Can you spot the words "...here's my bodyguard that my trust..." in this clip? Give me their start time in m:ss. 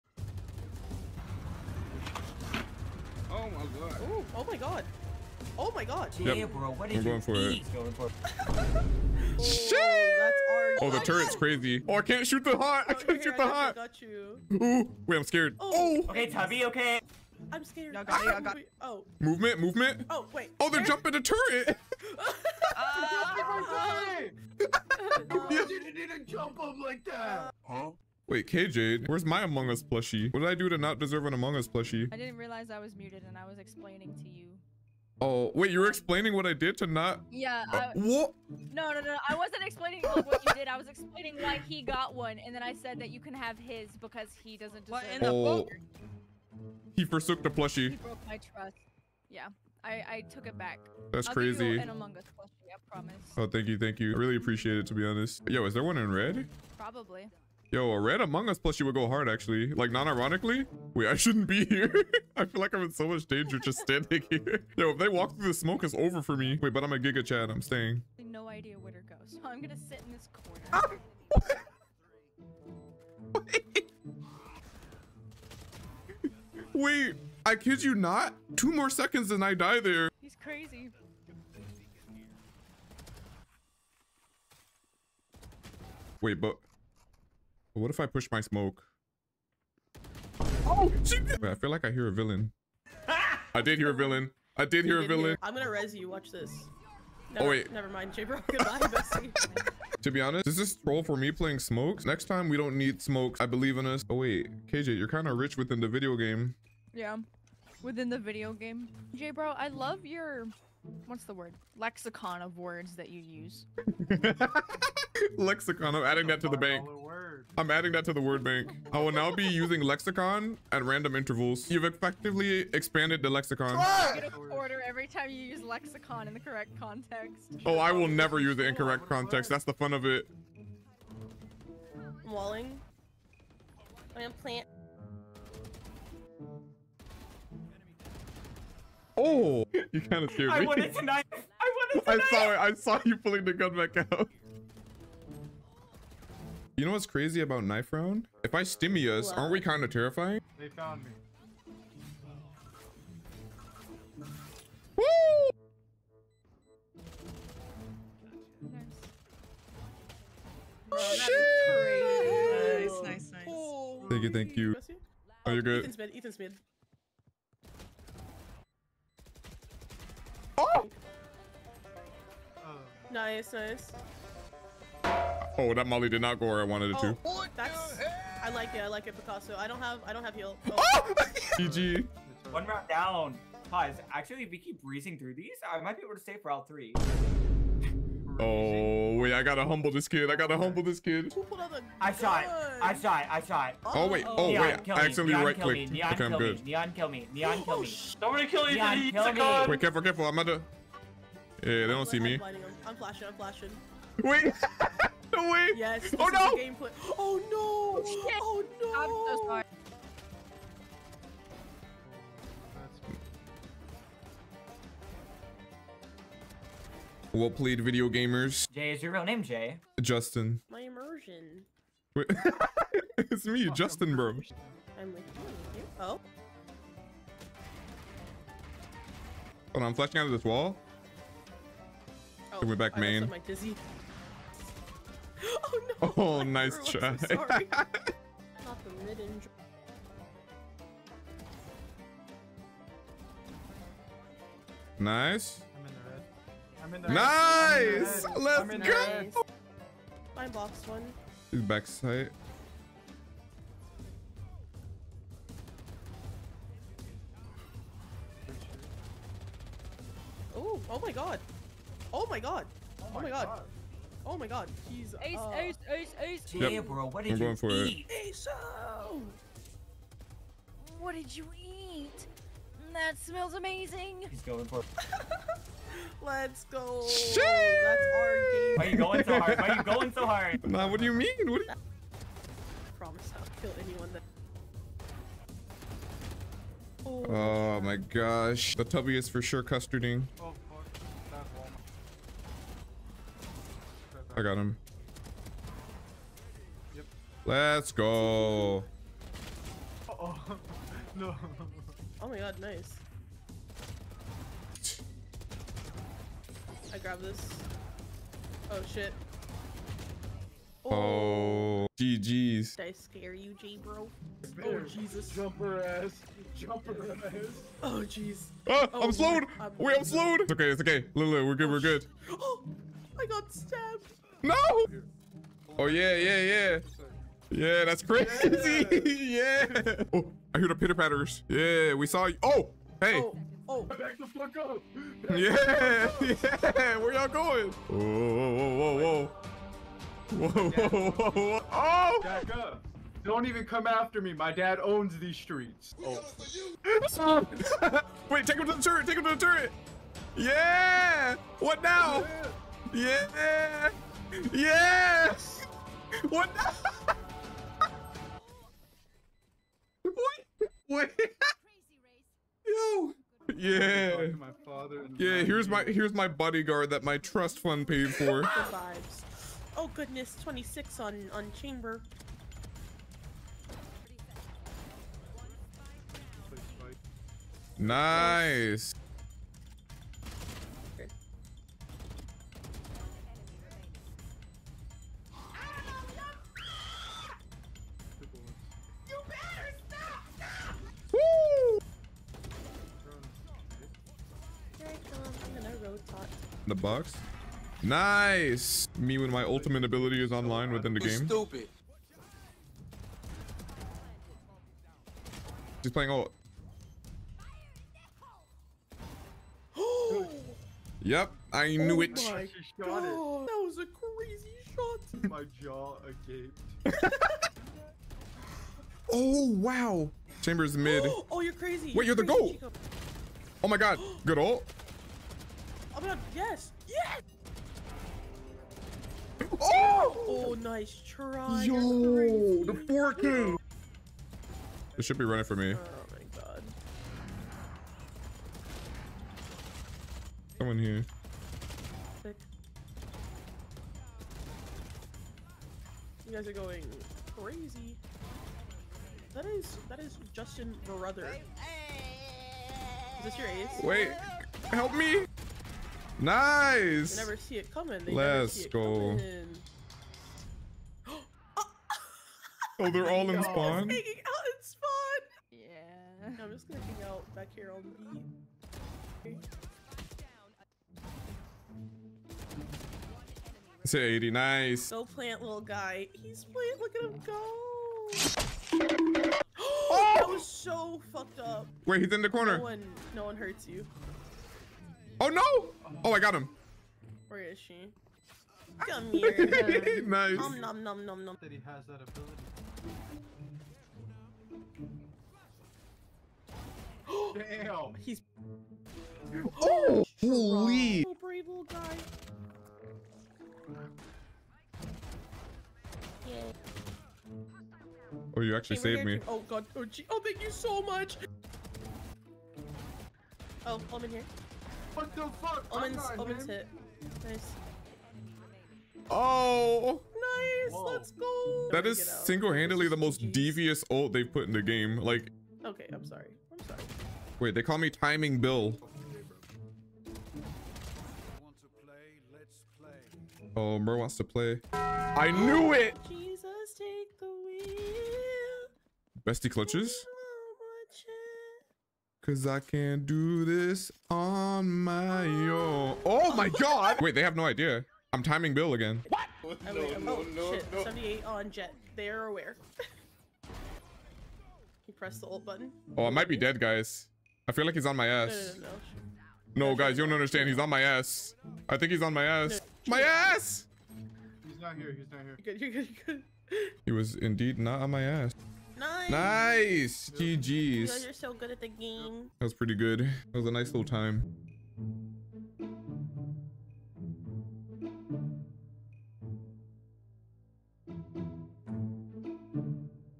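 6:05.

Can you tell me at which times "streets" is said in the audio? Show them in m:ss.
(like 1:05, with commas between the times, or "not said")
5:45.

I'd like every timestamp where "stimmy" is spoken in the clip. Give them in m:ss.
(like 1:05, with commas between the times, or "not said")
2:28.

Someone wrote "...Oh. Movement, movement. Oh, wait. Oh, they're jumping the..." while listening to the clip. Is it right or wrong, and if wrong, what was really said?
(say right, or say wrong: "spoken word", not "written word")
right.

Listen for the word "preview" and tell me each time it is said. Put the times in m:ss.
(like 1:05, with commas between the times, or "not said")
not said.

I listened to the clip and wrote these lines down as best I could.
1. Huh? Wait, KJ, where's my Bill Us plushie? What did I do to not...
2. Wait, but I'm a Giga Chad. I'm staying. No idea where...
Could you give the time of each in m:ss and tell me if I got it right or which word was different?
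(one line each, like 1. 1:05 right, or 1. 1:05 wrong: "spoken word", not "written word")
1. 0:27 wrong: "Among", not "Bill"
2. 1:06 right.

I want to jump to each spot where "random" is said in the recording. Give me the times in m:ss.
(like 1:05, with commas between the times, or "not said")
2:00.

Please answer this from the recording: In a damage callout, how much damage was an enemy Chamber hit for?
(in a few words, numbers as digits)
26.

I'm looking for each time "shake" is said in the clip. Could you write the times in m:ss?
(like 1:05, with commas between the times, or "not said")
not said.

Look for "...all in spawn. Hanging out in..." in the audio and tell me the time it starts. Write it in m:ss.
7:43.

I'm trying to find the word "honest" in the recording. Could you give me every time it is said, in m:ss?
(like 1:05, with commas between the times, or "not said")
0:55, 1:40.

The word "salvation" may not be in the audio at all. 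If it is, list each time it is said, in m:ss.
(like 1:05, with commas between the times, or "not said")
not said.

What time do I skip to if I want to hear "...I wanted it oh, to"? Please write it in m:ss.
2:56.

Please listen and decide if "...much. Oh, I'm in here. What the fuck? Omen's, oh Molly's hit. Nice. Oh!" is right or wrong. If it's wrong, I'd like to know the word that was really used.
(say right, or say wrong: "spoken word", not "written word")
wrong: "Omen", not "Molly".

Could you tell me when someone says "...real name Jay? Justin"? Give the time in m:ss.
3:39.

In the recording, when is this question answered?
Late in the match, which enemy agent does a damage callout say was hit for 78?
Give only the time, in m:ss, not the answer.
9:10.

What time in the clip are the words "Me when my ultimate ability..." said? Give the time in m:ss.
6:38.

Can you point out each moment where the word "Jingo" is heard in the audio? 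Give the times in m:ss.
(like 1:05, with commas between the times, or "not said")
not said.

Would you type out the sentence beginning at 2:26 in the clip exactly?
You know what's crazy about knife round?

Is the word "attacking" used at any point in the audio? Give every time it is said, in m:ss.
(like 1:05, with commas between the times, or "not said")
not said.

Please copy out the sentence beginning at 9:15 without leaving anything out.
Oh, I might be dead, guys.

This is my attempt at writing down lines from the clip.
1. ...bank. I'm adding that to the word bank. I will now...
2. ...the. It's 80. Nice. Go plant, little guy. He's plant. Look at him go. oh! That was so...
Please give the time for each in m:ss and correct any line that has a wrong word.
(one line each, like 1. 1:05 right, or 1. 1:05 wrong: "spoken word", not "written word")
1. 1:56 right
2. 7:47 right.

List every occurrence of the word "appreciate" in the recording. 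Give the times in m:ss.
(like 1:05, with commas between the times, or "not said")
0:54.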